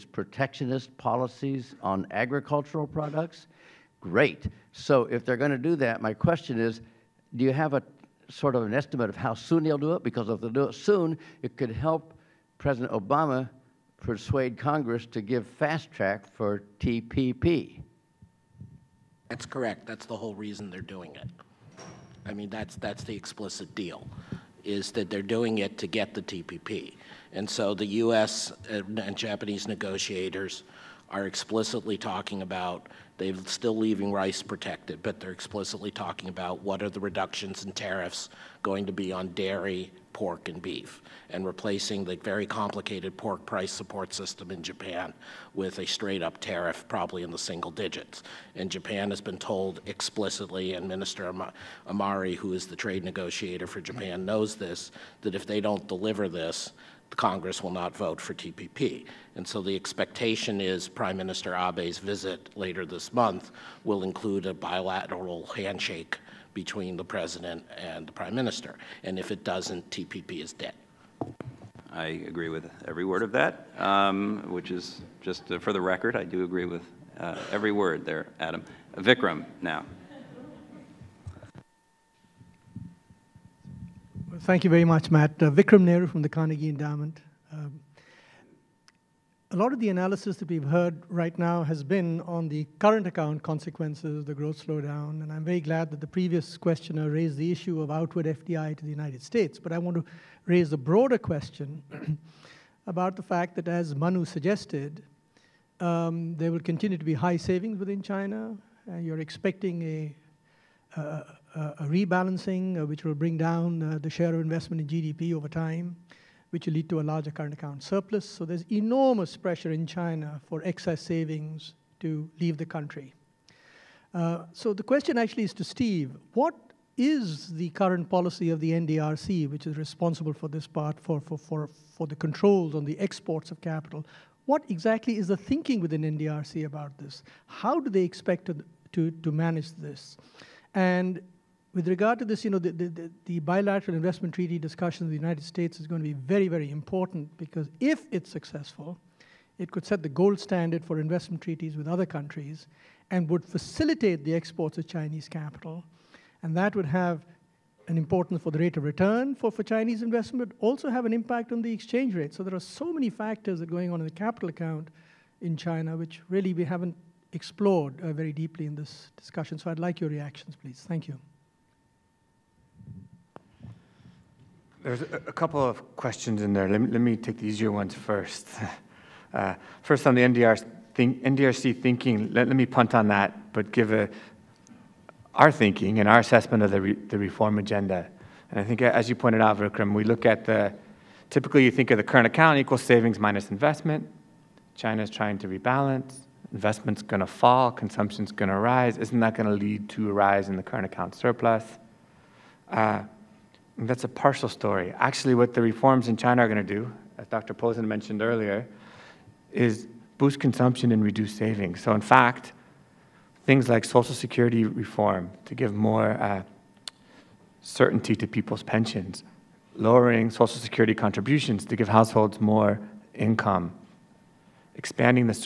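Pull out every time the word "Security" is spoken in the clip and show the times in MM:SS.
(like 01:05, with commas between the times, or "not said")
03:34, 03:40.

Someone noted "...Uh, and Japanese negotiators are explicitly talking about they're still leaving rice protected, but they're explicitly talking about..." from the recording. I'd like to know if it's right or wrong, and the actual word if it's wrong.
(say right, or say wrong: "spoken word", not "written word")
right.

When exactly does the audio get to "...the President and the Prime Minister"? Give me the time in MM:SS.
01:06.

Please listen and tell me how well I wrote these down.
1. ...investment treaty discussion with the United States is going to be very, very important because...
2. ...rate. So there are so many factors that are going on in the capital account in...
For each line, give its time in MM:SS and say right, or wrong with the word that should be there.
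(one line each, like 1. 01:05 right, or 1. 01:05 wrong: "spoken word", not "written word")
1. 02:23 right
2. 02:42 right.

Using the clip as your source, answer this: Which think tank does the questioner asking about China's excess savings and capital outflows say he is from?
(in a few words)
Carnegie Endowment.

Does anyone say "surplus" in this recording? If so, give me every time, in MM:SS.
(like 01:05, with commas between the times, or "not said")
01:57, 03:21.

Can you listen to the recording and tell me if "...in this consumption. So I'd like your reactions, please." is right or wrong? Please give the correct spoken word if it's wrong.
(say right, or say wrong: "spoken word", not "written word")
wrong: "discussion", not "consumption".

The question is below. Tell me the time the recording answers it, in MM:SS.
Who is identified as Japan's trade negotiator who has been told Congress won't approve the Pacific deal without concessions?
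00:50.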